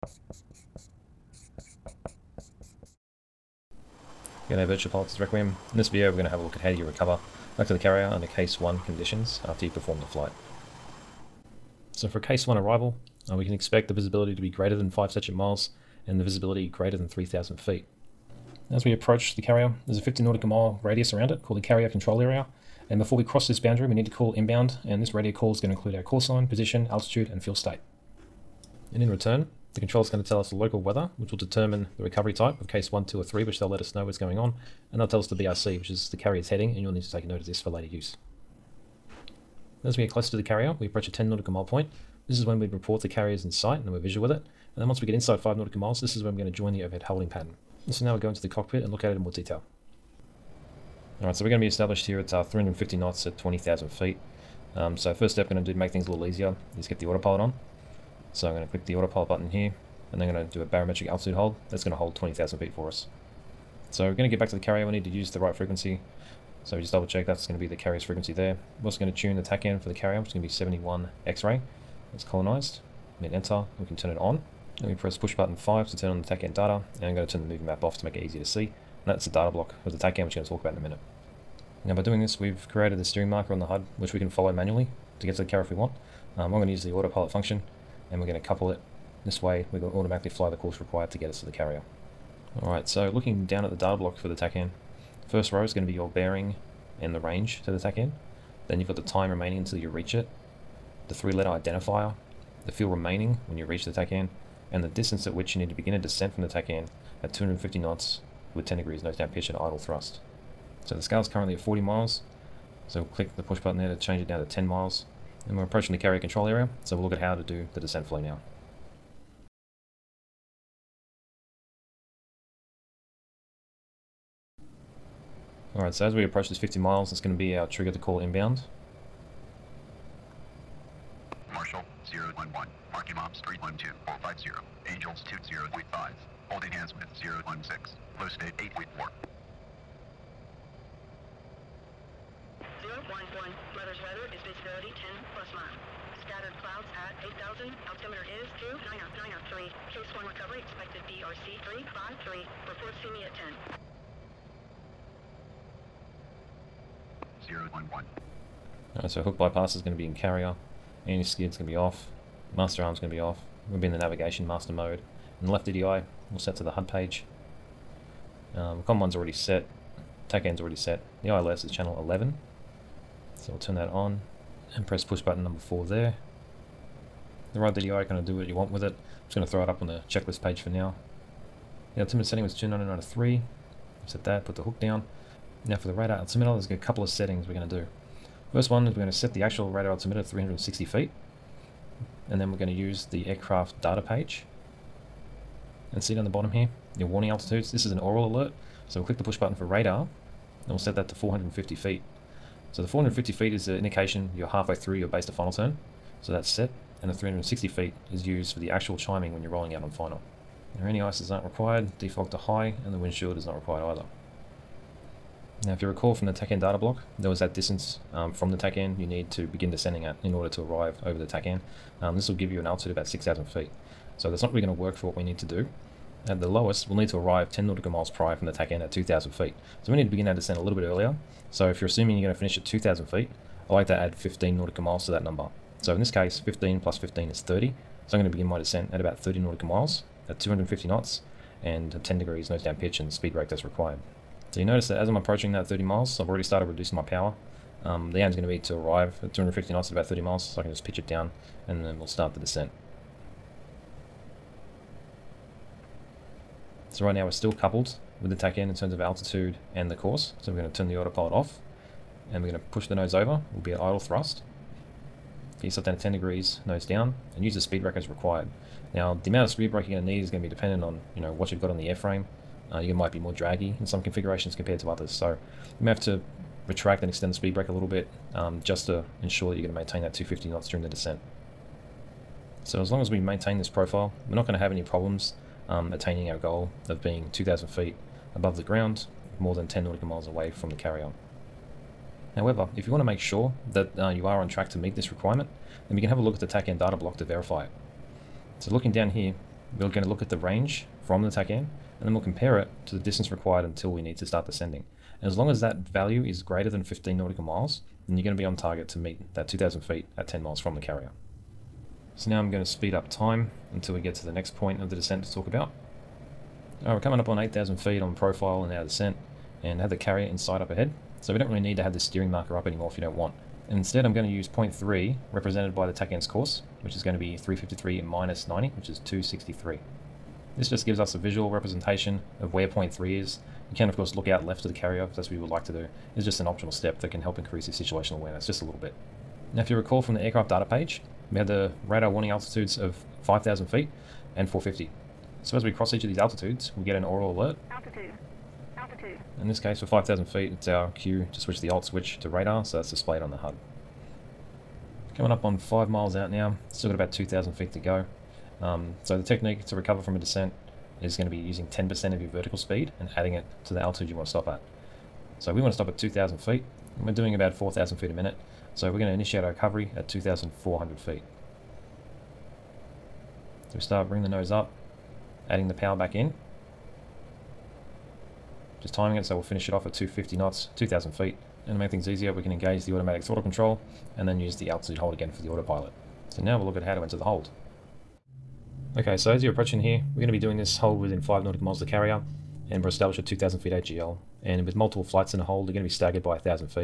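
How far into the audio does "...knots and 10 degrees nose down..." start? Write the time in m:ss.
4:00.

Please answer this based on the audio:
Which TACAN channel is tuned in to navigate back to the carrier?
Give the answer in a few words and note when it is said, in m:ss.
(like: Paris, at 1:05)
71X, at 1:10.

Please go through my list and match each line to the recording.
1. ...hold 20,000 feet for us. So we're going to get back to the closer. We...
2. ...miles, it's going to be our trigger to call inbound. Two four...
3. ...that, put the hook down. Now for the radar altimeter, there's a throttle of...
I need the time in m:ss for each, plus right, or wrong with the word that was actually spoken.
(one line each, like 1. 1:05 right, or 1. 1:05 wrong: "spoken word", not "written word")
1. 1:01 wrong: "carrier", not "closer"
2. 2:06 right
3. 3:04 wrong: "couple", not "throttle".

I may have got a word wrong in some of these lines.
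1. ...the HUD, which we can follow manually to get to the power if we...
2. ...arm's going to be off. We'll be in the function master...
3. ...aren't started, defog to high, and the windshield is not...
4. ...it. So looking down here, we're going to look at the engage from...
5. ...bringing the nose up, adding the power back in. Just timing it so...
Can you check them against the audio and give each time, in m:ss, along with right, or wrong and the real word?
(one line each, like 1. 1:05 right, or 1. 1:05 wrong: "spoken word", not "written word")
1. 1:23 wrong: "carrier", not "power"
2. 2:42 wrong: "navigation", not "function"
3. 3:31 wrong: "required", not "started"
4. 4:57 wrong: "range", not "engage"
5. 6:14 right.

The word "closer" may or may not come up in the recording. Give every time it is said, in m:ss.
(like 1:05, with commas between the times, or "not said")
0:40.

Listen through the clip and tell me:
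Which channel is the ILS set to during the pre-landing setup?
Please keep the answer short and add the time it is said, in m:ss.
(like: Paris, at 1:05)
11, at 2:51.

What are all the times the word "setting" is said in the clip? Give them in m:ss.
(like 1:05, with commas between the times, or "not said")
3:02, 3:07.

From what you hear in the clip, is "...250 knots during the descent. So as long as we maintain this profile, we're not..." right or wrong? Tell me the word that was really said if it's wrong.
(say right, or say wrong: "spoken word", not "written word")
right.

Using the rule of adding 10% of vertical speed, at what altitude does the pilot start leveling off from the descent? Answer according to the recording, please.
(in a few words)
2,400 feet.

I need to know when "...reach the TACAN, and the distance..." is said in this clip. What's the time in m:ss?
1:43.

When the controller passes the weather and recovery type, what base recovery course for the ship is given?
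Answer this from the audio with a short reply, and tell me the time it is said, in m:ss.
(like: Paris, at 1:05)
353, at 2:31.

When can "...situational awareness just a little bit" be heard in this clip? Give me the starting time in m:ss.
5:37.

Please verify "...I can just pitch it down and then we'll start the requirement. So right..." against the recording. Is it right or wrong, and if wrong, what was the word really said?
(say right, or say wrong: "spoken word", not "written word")
wrong: "descent", not "requirement".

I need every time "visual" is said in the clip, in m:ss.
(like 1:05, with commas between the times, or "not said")
0:43, 5:31.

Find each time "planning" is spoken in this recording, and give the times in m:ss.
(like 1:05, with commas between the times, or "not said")
not said.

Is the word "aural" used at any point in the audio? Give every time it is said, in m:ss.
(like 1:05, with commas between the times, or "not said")
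3:17, 5:47.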